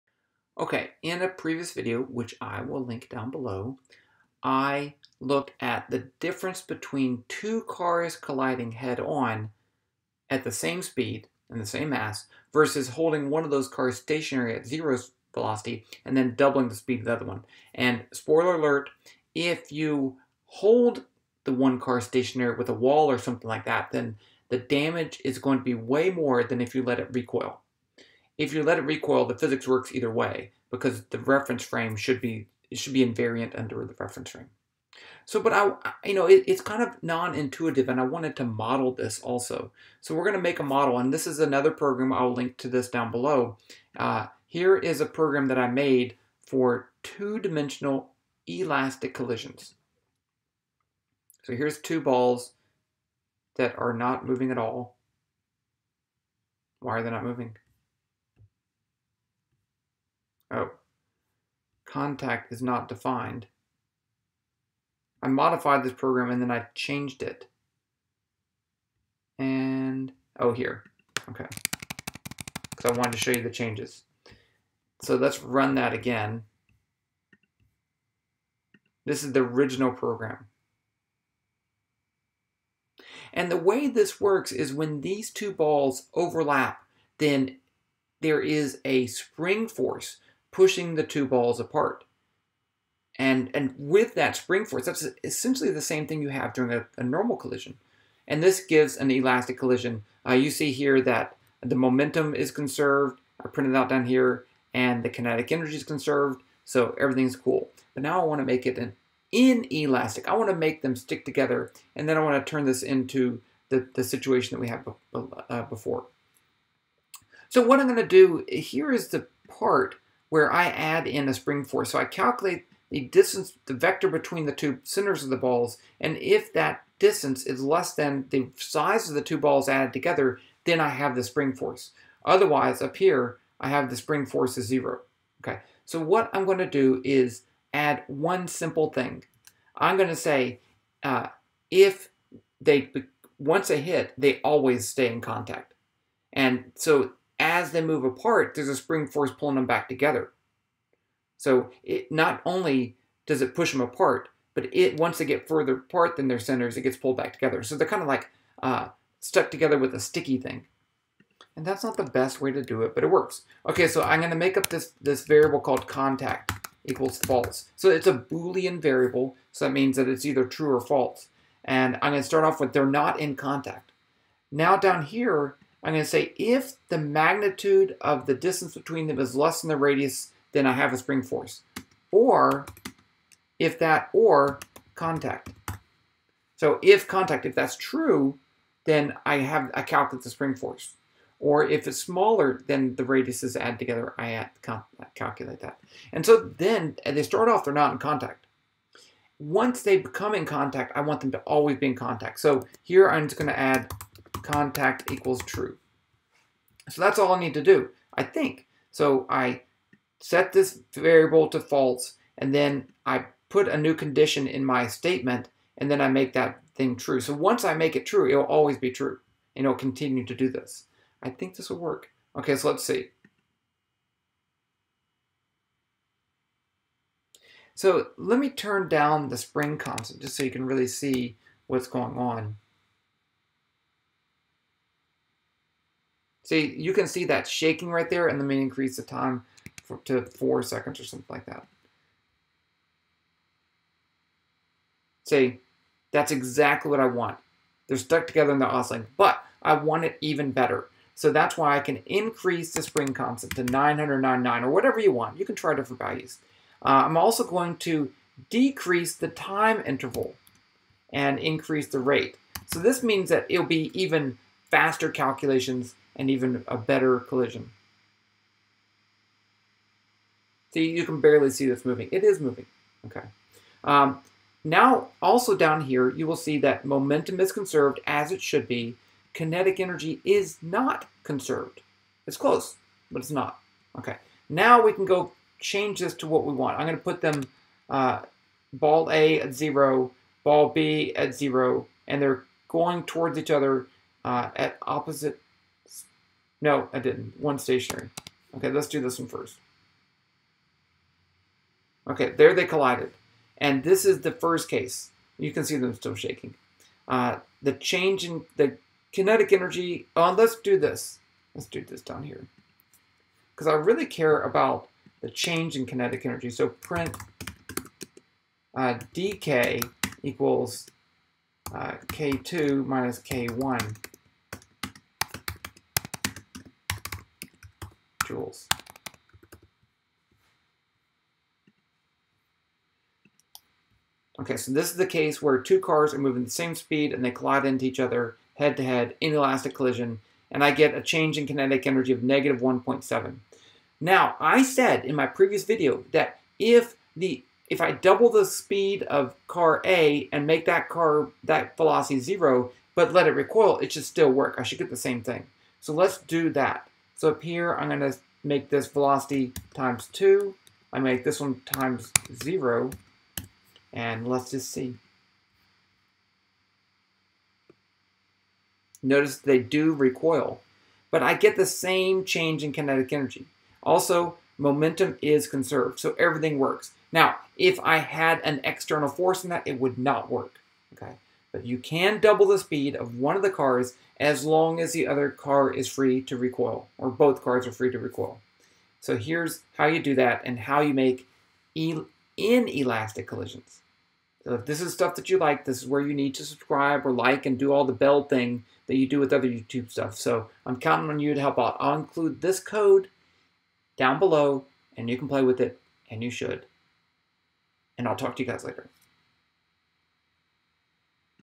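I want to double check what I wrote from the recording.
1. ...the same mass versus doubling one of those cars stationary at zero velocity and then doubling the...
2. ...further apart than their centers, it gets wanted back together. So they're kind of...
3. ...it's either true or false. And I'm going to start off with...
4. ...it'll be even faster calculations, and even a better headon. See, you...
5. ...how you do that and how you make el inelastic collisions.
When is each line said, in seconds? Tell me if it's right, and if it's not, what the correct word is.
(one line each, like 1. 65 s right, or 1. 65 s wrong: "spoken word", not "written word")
1. 11 s wrong: "holding", not "doubling"
2. 155 s wrong: "pulled", not "wanted"
3. 170 s right
4. 263 s wrong: "collision", not "headon"
5. 389 s right.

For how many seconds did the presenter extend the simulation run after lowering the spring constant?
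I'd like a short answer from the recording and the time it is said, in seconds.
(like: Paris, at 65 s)
4, at 240 s.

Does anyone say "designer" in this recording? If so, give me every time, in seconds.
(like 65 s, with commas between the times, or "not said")
not said.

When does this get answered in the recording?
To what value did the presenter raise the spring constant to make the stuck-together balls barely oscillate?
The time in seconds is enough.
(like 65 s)
253 s.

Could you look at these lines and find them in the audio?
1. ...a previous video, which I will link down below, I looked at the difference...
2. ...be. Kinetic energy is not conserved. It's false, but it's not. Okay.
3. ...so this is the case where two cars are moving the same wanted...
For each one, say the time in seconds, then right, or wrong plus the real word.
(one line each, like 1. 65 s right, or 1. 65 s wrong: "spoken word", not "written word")
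1. 1 s right
2. 278 s wrong: "close", not "false"
3. 334 s wrong: "speed", not "wanted".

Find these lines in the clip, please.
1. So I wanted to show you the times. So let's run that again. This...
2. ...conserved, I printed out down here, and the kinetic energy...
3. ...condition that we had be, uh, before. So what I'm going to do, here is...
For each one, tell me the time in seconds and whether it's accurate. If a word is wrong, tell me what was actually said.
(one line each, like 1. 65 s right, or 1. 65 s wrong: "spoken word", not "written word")
1. 72 s wrong: "changes", not "times"
2. 102 s right
3. 114 s wrong: "situation", not "condition".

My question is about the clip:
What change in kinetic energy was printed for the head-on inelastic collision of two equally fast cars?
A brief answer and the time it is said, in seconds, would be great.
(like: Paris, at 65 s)
-1.7, at 342 s.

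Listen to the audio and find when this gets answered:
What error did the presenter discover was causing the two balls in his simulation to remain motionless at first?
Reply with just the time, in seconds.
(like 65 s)
61 s.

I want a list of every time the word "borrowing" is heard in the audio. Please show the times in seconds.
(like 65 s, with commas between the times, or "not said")
not said.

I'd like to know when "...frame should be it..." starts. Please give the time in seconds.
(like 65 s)
31 s.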